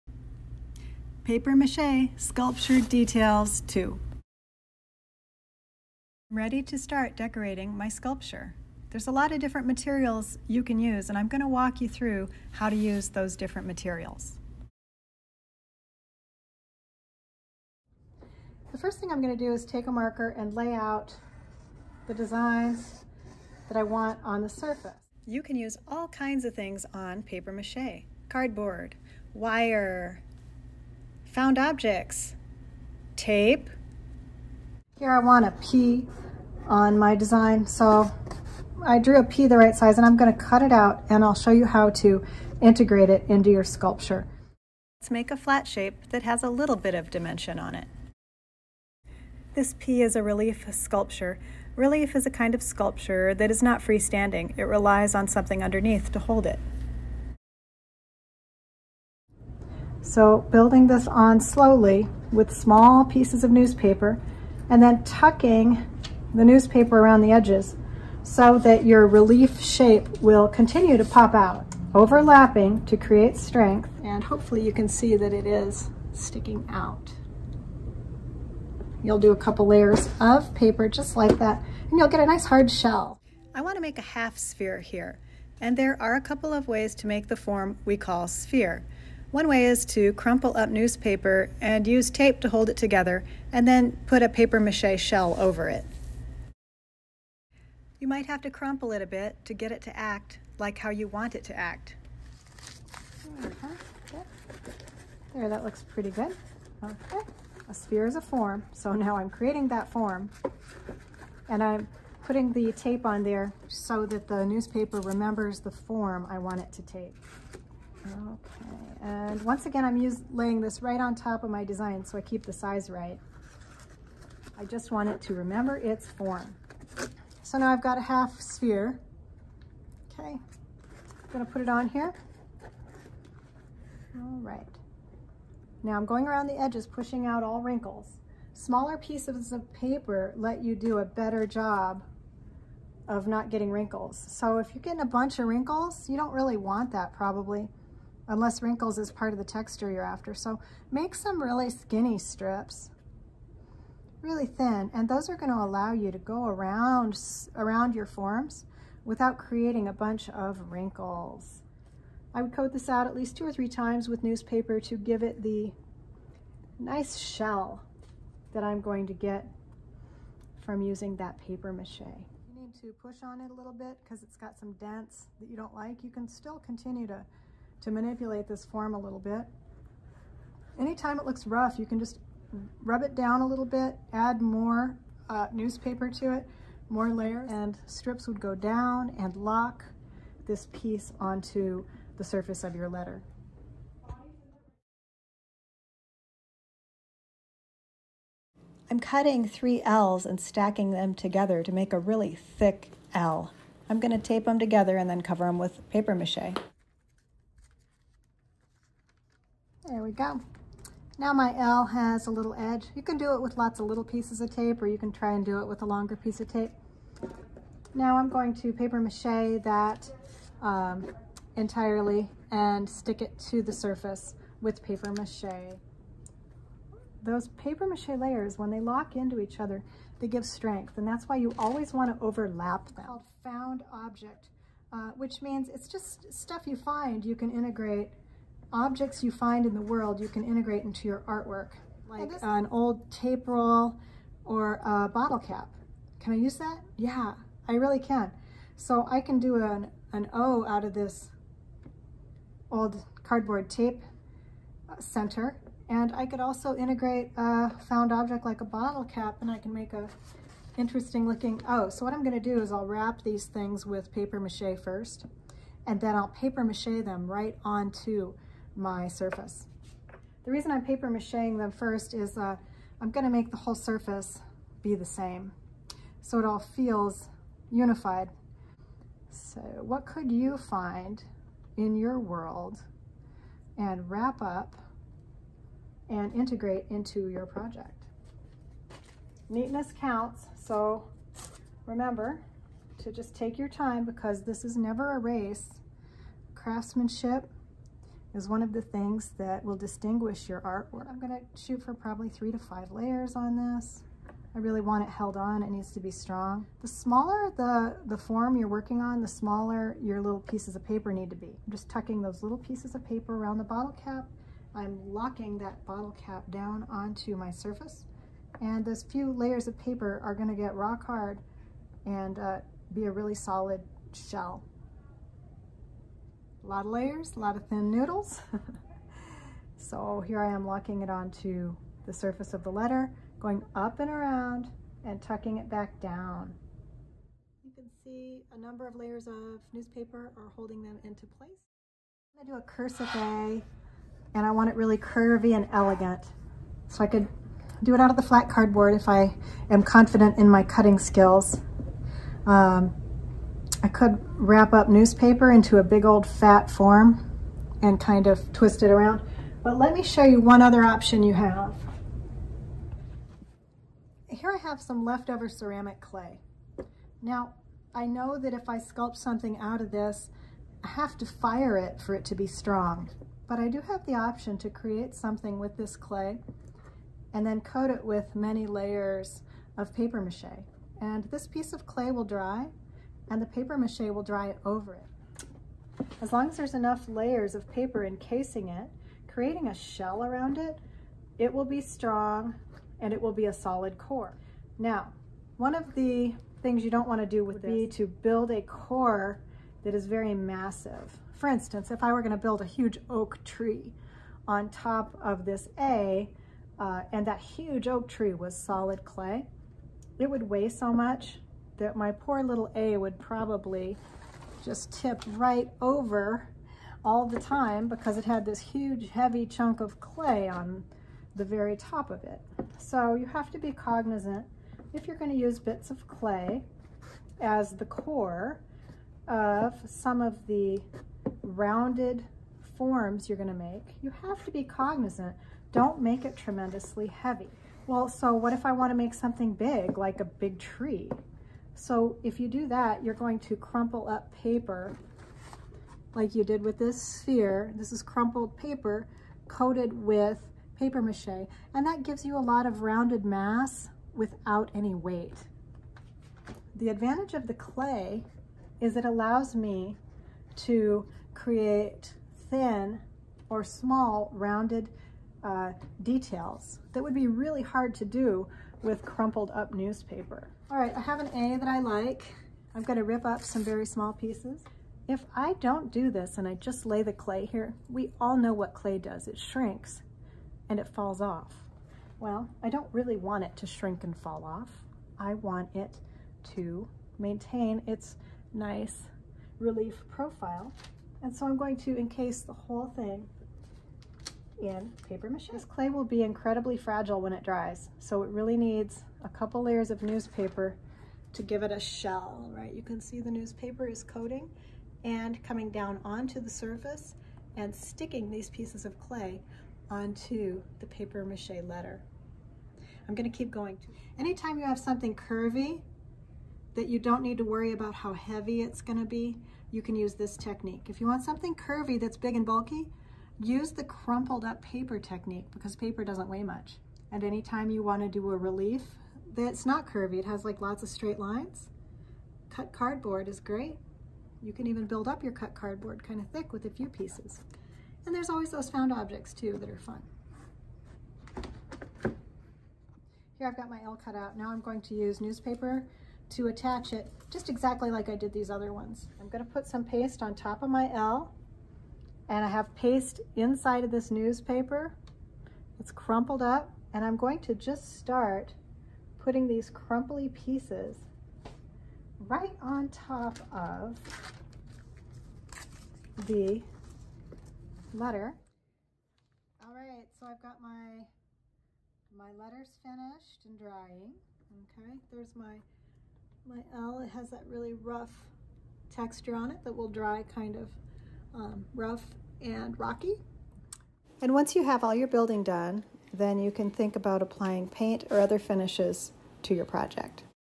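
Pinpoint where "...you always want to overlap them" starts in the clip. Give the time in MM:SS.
03:51.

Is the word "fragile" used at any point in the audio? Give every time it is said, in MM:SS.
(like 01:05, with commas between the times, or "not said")
08:16.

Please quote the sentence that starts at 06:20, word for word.
And this piece of clay will dry and the paper mache will dry over it.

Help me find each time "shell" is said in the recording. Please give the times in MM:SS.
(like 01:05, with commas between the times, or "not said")
01:22, 01:34, 02:47, 05:24, 06:29, 08:21.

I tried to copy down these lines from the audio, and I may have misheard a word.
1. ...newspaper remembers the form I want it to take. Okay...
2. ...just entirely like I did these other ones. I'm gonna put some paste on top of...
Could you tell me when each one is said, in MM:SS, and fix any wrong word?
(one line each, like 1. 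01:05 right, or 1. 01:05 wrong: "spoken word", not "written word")
1. 01:54 right
2. 09:07 wrong: "exactly", not "entirely".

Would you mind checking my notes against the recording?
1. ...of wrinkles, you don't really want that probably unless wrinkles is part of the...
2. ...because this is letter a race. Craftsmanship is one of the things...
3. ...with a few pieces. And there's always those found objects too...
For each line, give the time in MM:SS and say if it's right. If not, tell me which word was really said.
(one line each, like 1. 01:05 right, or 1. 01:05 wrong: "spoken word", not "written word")
1. 02:25 right
2. 04:54 wrong: "never", not "letter"
3. 08:56 right.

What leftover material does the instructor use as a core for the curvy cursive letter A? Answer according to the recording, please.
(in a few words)
Ceramic clay.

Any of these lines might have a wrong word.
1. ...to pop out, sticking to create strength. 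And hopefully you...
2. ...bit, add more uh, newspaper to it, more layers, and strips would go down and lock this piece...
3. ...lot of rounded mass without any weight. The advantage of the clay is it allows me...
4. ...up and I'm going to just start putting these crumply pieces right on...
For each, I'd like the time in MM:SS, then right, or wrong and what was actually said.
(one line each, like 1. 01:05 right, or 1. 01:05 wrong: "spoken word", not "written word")
1. 01:10 wrong: "overlapping", not "sticking"
2. 03:03 right
3. 07:32 right
4. 09:16 right.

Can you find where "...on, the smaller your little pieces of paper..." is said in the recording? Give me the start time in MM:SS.
05:09.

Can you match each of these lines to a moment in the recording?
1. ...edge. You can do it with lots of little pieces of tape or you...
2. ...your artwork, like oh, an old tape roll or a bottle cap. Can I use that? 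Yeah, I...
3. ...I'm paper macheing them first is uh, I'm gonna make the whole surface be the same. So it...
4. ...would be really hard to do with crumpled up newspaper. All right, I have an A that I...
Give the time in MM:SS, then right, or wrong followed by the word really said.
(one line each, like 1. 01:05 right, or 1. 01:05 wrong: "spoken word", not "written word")
1. 03:32 right
2. 04:01 right
3. 04:30 right
4. 07:47 right.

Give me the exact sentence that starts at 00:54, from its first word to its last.
It relies on something underneath to hold it.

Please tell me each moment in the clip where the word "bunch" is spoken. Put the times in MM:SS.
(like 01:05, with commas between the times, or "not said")
02:25, 02:39.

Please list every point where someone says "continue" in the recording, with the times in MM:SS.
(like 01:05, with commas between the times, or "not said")
01:10, 02:56.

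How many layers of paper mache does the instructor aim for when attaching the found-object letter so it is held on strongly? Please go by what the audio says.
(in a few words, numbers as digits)
3 to 5.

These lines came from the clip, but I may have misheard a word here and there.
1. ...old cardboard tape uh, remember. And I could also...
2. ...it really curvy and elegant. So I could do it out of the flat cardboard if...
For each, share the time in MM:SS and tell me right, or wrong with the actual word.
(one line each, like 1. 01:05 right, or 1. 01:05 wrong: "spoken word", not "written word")
1. 04:12 wrong: "center", not "remember"
2. 05:44 right.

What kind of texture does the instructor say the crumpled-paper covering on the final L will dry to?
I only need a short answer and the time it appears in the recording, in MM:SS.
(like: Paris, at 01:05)
Rough and rocky, at 09:41.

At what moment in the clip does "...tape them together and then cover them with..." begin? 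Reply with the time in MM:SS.
03:24.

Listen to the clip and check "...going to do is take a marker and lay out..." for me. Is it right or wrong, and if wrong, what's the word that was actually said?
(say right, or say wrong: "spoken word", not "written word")
right.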